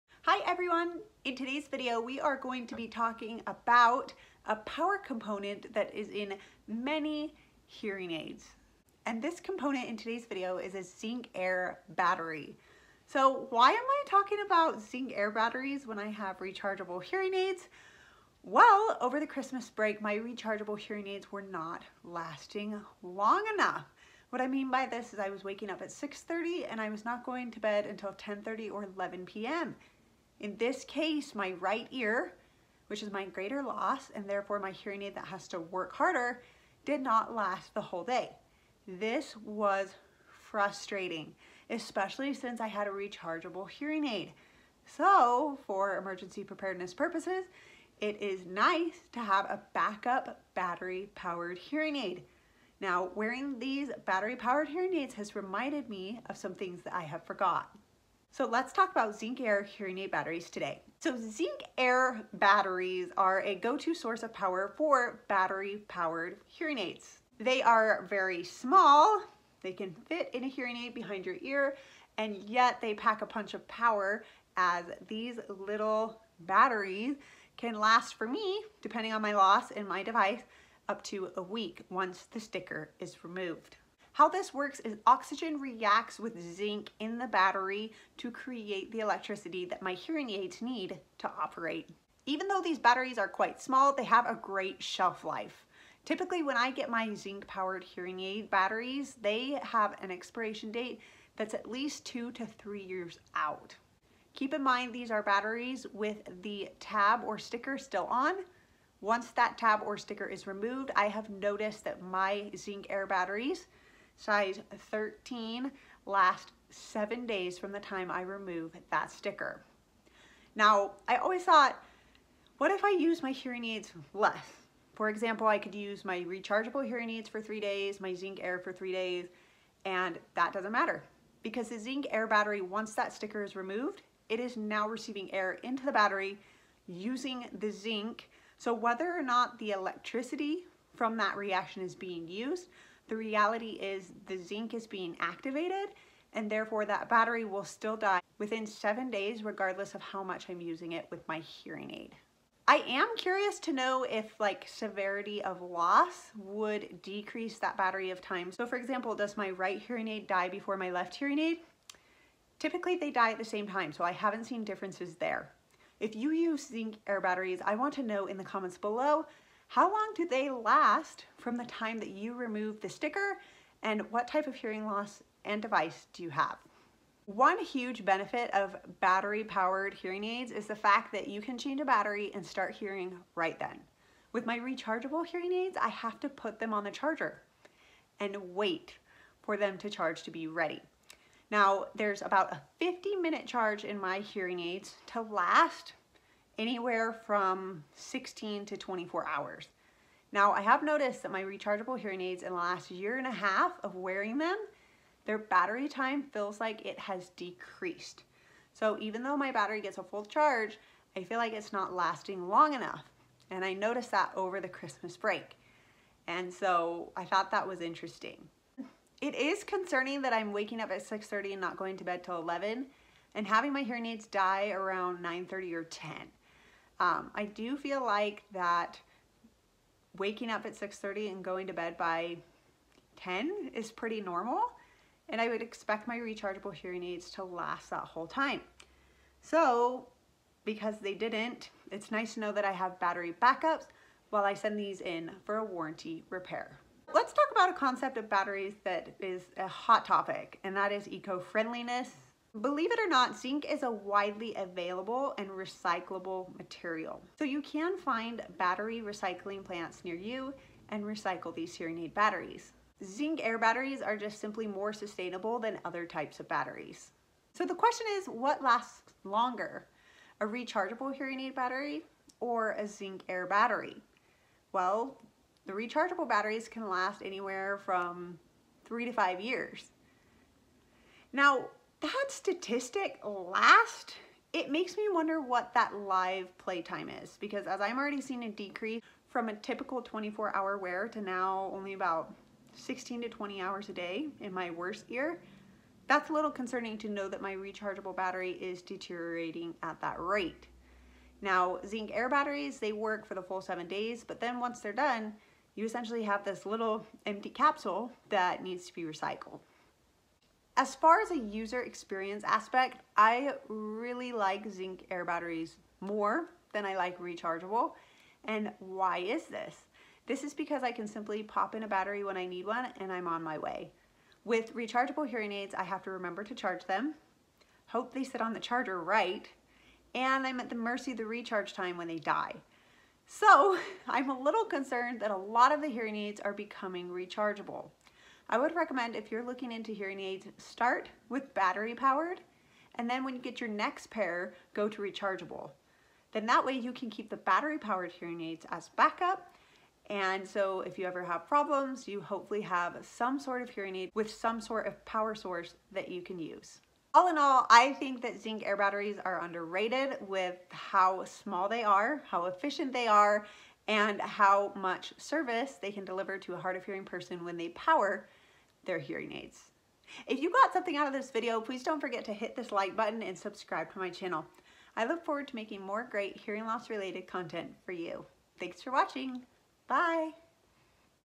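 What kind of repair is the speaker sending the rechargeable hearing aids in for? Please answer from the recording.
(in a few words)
warranty repair.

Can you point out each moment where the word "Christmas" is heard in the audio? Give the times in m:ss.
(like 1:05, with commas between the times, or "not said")
0:19, 3:34.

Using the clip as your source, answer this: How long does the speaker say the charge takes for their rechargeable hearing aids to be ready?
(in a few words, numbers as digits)
50 minutes.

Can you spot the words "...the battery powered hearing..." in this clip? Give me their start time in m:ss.
5:47.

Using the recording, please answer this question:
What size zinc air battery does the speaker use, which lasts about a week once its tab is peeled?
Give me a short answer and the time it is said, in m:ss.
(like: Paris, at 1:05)
13, at 1:54.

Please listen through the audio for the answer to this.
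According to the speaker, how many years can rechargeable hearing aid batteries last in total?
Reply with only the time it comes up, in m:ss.
4:38.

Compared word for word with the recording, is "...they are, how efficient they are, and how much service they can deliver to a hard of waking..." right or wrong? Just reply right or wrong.
wrong.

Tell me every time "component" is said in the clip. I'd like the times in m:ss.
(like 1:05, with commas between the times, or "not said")
0:04, 0:09.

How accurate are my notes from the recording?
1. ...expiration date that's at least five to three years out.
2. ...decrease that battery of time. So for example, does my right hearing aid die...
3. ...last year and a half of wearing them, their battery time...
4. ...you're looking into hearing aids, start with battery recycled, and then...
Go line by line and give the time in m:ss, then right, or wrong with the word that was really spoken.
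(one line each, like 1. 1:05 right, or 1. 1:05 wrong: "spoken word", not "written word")
1. 1:40 wrong: "two", not "five"
2. 2:37 right
3. 3:22 right
4. 5:39 wrong: "powered", not "recycled".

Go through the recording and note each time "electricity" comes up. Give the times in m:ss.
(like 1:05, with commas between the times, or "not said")
1:28, 2:19.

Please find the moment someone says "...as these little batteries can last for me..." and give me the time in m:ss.
1:14.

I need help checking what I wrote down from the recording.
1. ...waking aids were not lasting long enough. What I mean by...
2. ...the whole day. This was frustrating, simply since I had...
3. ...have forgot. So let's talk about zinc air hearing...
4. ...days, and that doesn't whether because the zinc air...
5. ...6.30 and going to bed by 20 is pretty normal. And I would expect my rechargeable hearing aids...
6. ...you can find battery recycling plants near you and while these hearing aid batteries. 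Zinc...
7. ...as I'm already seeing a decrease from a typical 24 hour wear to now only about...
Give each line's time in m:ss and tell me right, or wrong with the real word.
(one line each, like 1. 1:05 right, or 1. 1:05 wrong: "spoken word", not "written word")
1. 0:20 wrong: "hearing", not "waking"
2. 0:37 wrong: "especially", not "simply"
3. 0:57 right
4. 2:08 wrong: "matter", not "whether"
5. 3:50 wrong: "10", not "20"
6. 4:17 wrong: "recycle", not "while"
7. 4:47 right.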